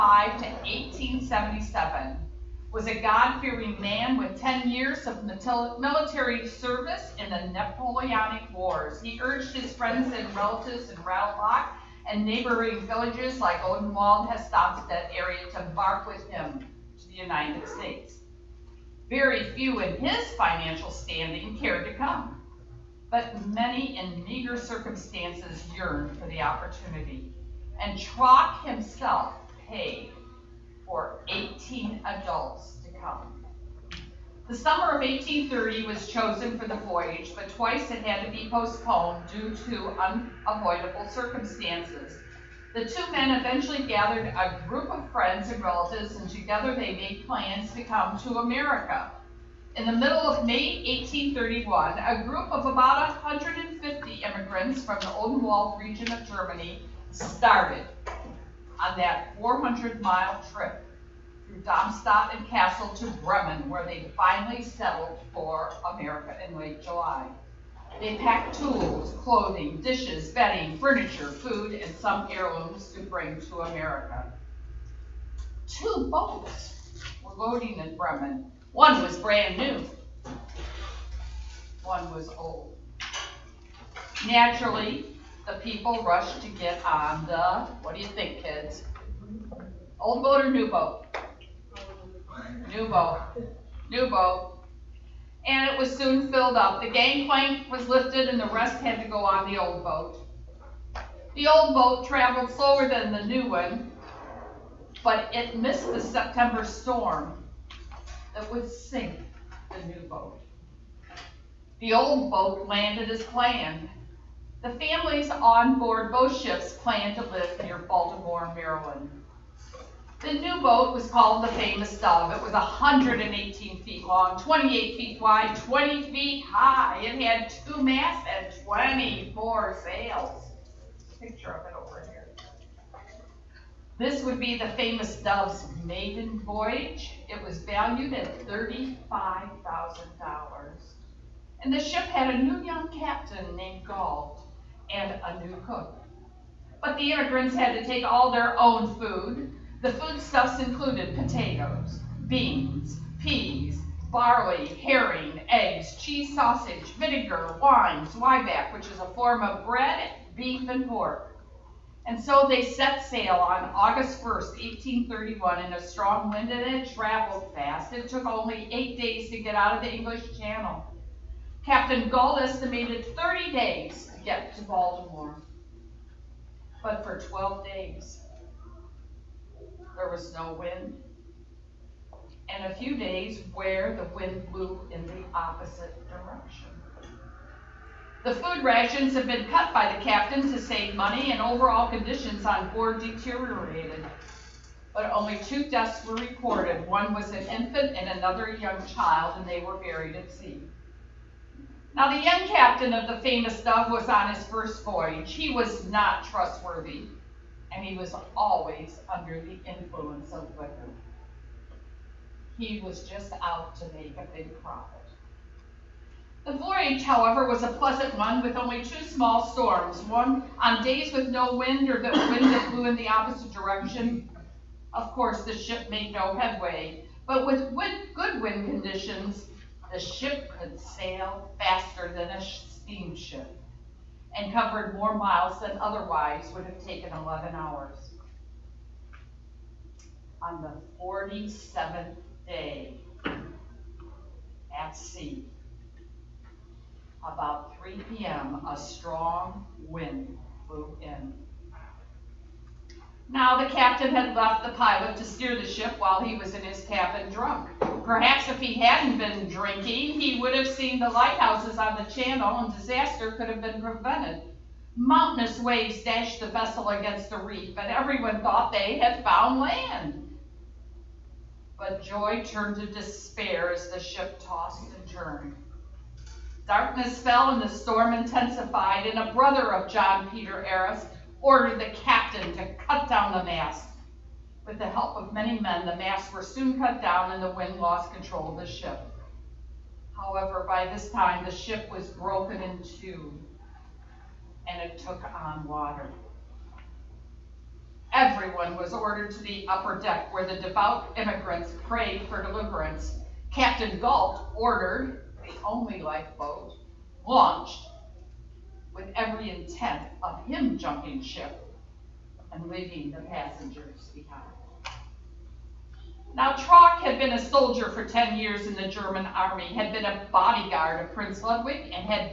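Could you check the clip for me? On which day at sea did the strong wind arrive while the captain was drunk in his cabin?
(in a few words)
47th.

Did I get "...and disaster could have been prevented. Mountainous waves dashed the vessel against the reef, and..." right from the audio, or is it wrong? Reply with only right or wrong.
right.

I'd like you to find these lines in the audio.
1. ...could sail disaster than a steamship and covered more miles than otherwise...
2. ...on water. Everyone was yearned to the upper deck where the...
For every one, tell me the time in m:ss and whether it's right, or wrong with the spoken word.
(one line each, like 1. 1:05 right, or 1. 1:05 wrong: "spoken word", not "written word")
1. 3:50 wrong: "faster", not "disaster"
2. 4:55 wrong: "ordered", not "yearned".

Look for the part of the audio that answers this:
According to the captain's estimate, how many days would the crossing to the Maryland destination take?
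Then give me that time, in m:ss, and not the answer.
2:53.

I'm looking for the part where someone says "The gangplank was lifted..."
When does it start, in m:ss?
1:36.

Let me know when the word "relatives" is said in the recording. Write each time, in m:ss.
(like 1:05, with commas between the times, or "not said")
0:10, 0:45.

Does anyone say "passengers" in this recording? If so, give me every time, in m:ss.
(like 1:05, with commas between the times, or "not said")
5:13.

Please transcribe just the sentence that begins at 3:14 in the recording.
But only two deaths were recorded: One was an infant and another a young child, and they were buried at sea.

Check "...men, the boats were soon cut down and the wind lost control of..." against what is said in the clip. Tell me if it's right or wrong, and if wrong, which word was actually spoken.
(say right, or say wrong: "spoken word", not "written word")
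wrong: "masts", not "boats".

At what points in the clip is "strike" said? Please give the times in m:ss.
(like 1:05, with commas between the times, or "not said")
not said.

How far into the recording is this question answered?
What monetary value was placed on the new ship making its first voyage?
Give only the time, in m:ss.
2:18.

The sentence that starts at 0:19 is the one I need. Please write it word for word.
Very few in his financial standing cared to come, but many in meager circumstances yearned for the opportunity.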